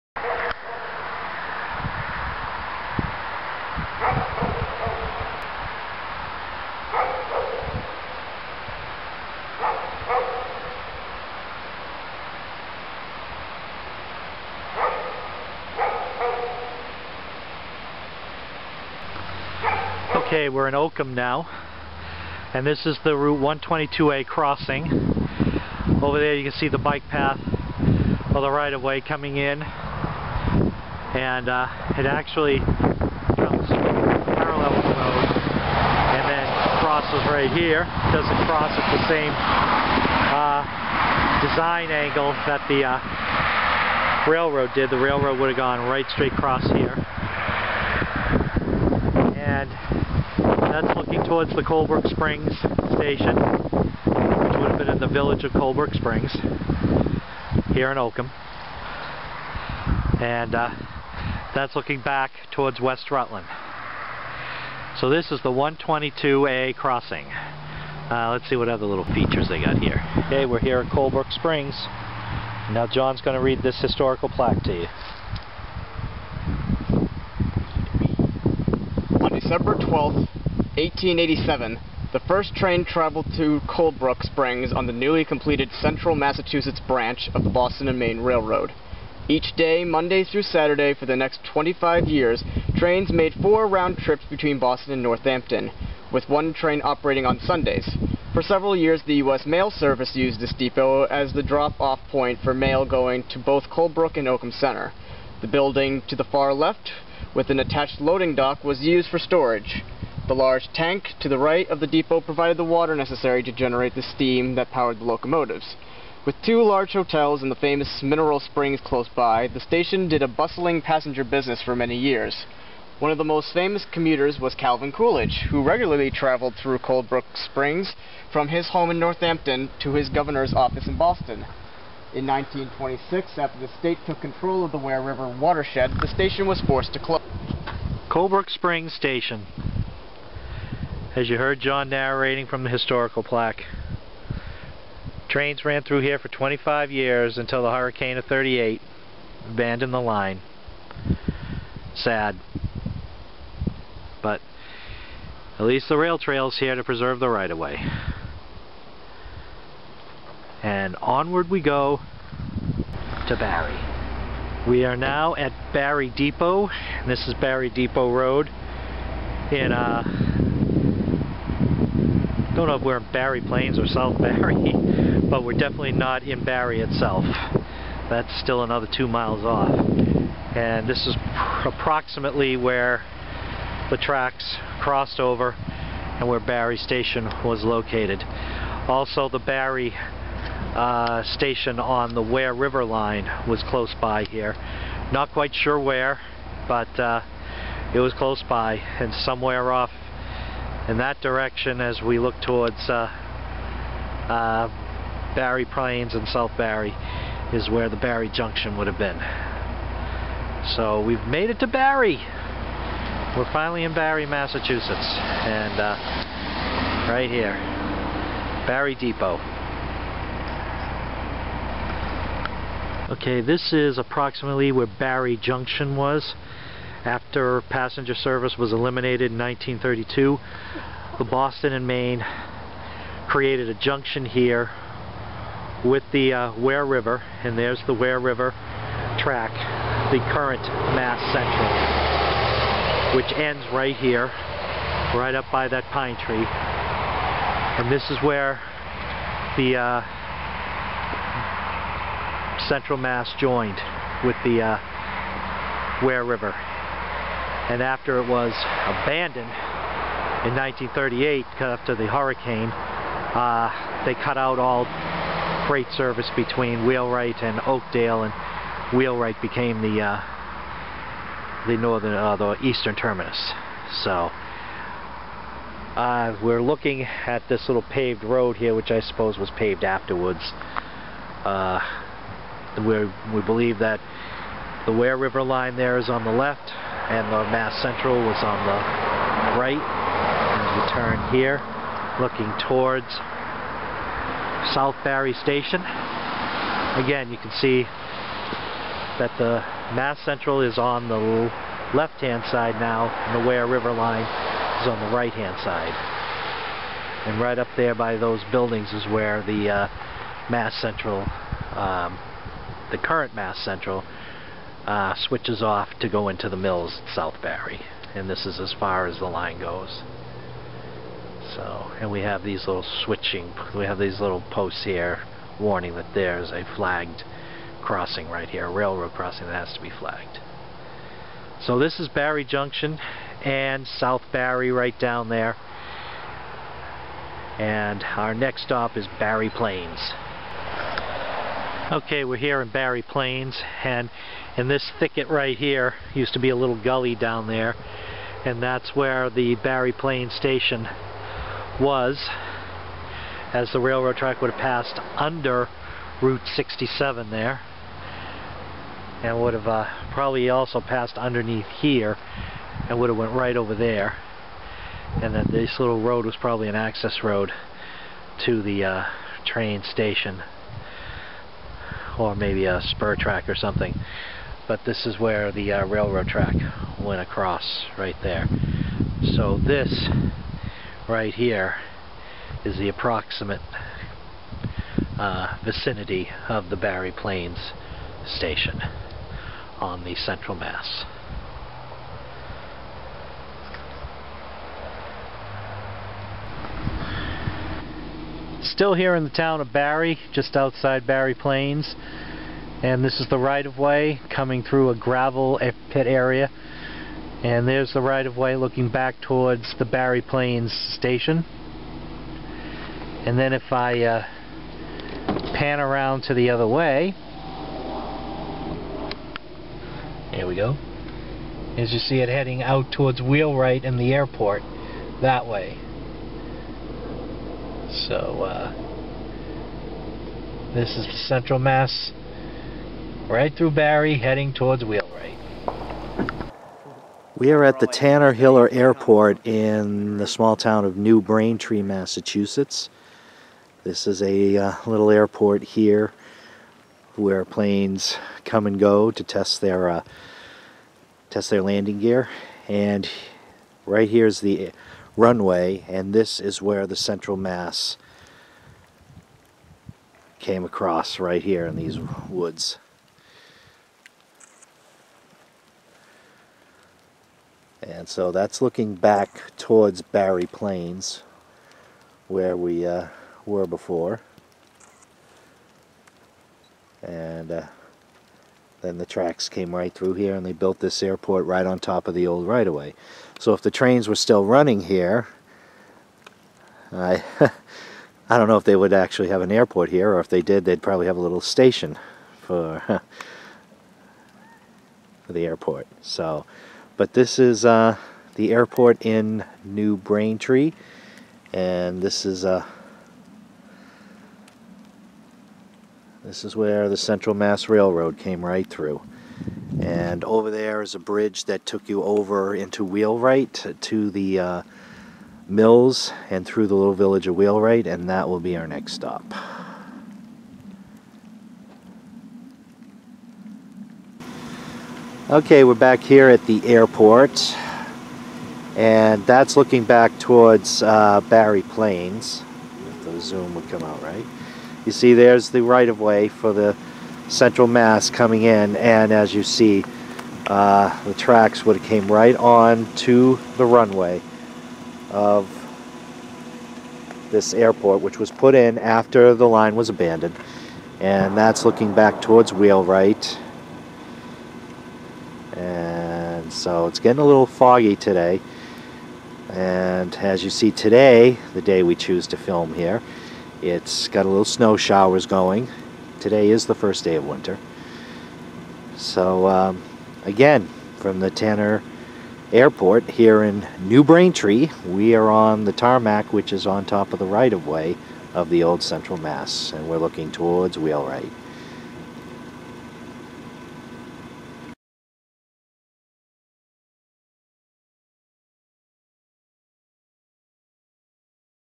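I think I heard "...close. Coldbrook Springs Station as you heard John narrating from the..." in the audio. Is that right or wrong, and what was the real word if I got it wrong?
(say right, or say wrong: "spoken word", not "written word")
right.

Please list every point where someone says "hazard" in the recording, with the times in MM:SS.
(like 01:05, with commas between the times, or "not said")
not said.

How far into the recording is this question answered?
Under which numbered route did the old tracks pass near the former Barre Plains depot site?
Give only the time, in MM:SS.
05:56.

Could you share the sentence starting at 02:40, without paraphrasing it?
And onward we go to Barre.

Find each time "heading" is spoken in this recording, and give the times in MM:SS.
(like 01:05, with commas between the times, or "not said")
07:02, 07:14.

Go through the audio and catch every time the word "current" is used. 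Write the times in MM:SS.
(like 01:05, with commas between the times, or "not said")
04:00, 05:12.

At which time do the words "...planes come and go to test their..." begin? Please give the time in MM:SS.
07:27.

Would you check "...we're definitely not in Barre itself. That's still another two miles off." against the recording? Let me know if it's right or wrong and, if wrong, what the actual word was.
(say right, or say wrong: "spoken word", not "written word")
right.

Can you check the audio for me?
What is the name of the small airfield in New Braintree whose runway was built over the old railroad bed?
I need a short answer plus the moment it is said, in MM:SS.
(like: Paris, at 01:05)
Tanner Hiller Airport, at 07:17.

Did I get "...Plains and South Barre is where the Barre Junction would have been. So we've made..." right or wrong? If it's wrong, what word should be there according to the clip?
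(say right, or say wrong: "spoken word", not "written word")
right.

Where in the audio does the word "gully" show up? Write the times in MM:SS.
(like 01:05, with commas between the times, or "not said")
05:46.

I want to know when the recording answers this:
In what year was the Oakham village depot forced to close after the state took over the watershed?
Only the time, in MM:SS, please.
02:12.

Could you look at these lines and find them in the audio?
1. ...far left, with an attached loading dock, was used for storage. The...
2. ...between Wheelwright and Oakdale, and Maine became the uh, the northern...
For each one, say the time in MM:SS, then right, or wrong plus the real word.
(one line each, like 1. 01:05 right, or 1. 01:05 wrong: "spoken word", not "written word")
1. 01:46 right
2. 04:26 wrong: "Wheelwright", not "Maine".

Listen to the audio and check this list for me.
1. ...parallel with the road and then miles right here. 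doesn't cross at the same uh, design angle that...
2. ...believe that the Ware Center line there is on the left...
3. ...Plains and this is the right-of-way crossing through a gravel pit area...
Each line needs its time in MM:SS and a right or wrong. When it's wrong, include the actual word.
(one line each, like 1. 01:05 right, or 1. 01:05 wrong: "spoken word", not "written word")
1. 00:34 wrong: "crosses", not "miles"
2. 04:43 wrong: "River", not "Center"
3. 06:41 wrong: "coming", not "crossing".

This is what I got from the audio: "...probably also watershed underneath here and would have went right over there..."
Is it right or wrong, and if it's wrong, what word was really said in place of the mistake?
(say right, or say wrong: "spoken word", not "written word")
wrong: "passed", not "watershed".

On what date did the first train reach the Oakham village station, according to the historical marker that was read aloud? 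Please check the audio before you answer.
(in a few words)
December 12, 1887.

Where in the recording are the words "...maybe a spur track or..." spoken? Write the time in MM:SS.
06:12.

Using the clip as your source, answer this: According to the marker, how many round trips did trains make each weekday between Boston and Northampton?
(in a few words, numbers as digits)
4.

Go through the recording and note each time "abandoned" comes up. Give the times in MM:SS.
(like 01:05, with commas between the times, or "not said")
02:29, 04:19, 09:09.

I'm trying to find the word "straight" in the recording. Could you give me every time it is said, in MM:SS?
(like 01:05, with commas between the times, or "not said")
00:46.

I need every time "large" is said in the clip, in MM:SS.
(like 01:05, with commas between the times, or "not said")
01:50, 01:56.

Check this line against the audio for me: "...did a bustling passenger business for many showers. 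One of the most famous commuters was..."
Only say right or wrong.
wrong.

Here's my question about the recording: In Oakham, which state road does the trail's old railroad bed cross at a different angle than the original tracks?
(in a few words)
122A.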